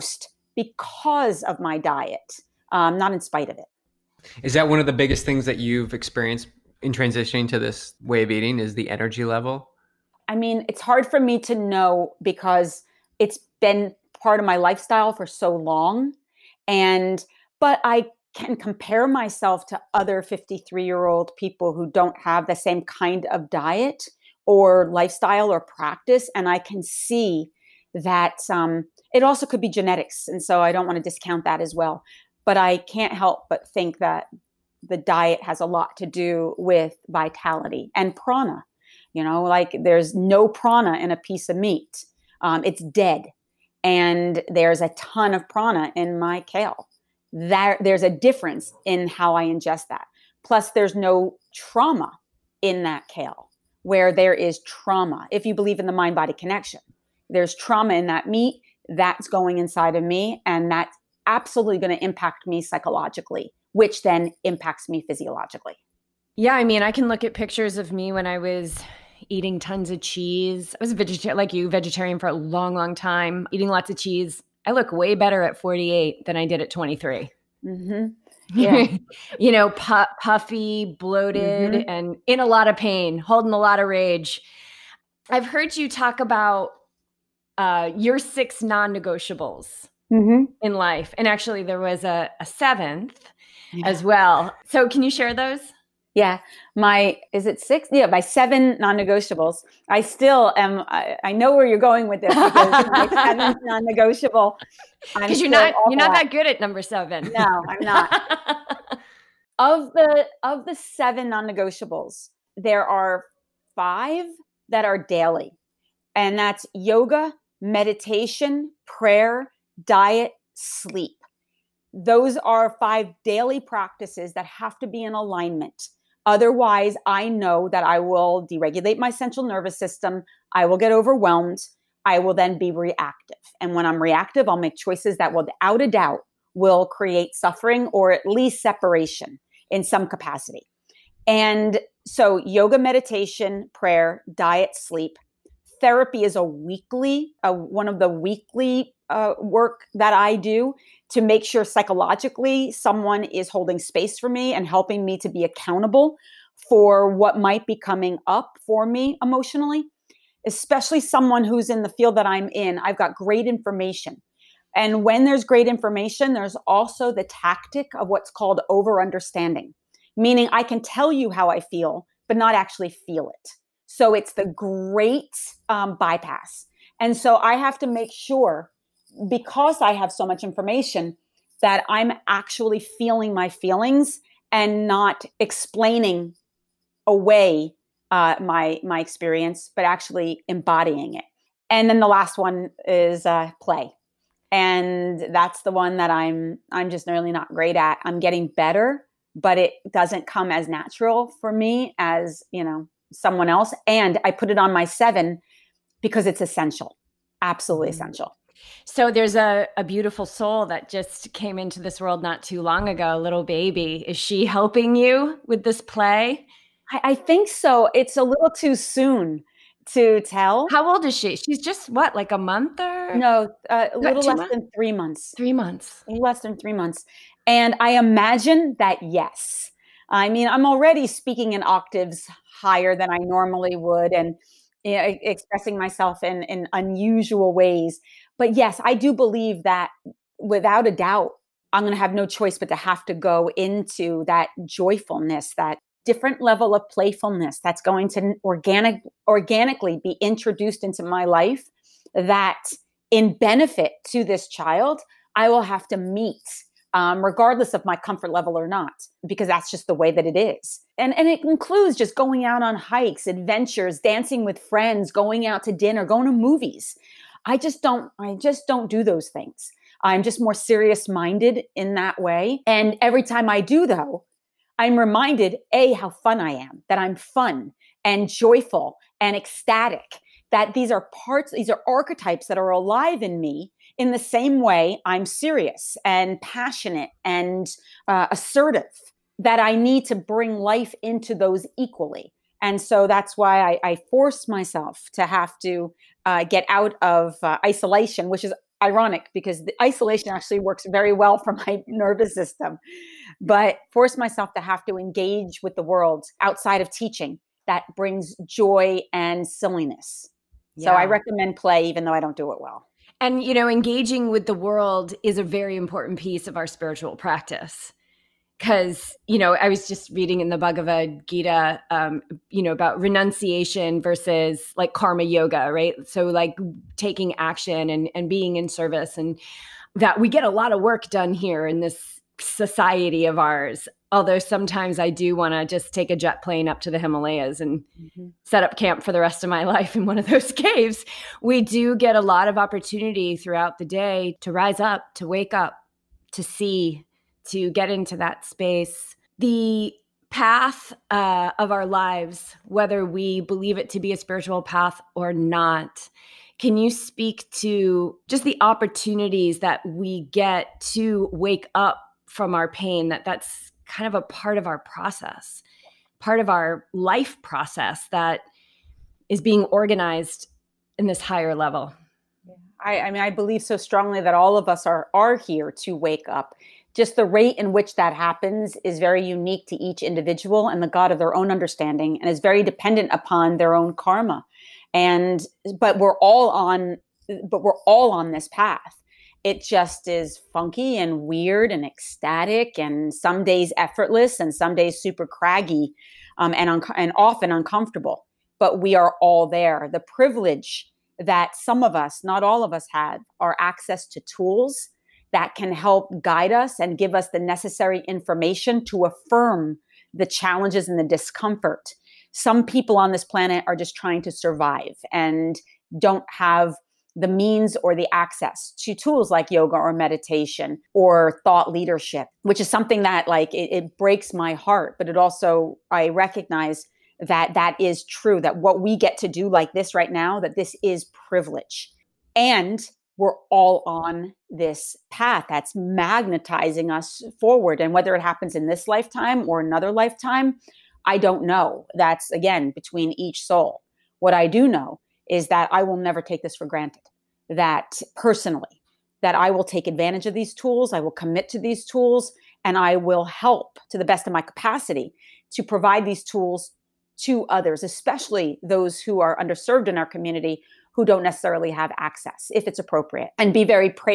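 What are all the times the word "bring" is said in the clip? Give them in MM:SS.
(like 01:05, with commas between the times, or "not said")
04:50, 05:07.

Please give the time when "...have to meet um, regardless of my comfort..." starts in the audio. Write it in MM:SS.
04:15.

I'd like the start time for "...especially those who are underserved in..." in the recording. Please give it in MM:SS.
07:37.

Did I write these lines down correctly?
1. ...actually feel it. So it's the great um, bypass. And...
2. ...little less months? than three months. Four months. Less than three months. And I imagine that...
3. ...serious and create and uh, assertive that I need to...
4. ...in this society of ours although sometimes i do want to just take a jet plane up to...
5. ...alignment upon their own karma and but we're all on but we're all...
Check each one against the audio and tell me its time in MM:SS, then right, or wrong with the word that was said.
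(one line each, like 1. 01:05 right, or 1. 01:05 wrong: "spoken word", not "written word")
1. 02:52 right
2. 03:43 wrong: "Three", not "Four"
3. 04:45 wrong: "passionate", not "create"
4. 05:31 right
5. 06:22 wrong: "dependent", not "alignment".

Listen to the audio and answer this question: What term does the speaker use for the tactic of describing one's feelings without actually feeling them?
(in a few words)
Over understanding.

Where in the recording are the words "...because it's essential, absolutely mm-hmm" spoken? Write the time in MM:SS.
03:26.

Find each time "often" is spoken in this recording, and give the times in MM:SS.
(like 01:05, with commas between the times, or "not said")
06:37.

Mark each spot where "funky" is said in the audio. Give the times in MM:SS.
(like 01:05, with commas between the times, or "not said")
06:30.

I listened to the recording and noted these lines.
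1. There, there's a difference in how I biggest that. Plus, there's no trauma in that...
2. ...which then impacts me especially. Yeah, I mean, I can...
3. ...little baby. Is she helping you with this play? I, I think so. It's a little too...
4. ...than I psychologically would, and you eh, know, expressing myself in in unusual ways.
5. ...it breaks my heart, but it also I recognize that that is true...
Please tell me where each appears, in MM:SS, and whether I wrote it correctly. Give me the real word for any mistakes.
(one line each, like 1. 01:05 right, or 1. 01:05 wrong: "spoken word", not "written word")
1. 00:47 wrong: "ingest", not "biggest"
2. 01:03 wrong: "physiologically", not "especially"
3. 03:33 right
4. 03:52 wrong: "normally", not "psychologically"
5. 07:03 right.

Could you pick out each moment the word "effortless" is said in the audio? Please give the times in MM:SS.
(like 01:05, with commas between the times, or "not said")
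06:33.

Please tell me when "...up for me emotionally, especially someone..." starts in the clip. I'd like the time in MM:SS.
02:38.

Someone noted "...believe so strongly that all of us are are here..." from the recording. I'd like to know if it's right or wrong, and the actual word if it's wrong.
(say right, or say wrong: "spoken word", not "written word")
right.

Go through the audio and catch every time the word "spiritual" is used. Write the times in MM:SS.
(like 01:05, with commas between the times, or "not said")
05:16, 05:54.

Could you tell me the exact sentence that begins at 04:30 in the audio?
I'm just more serious minded in that way.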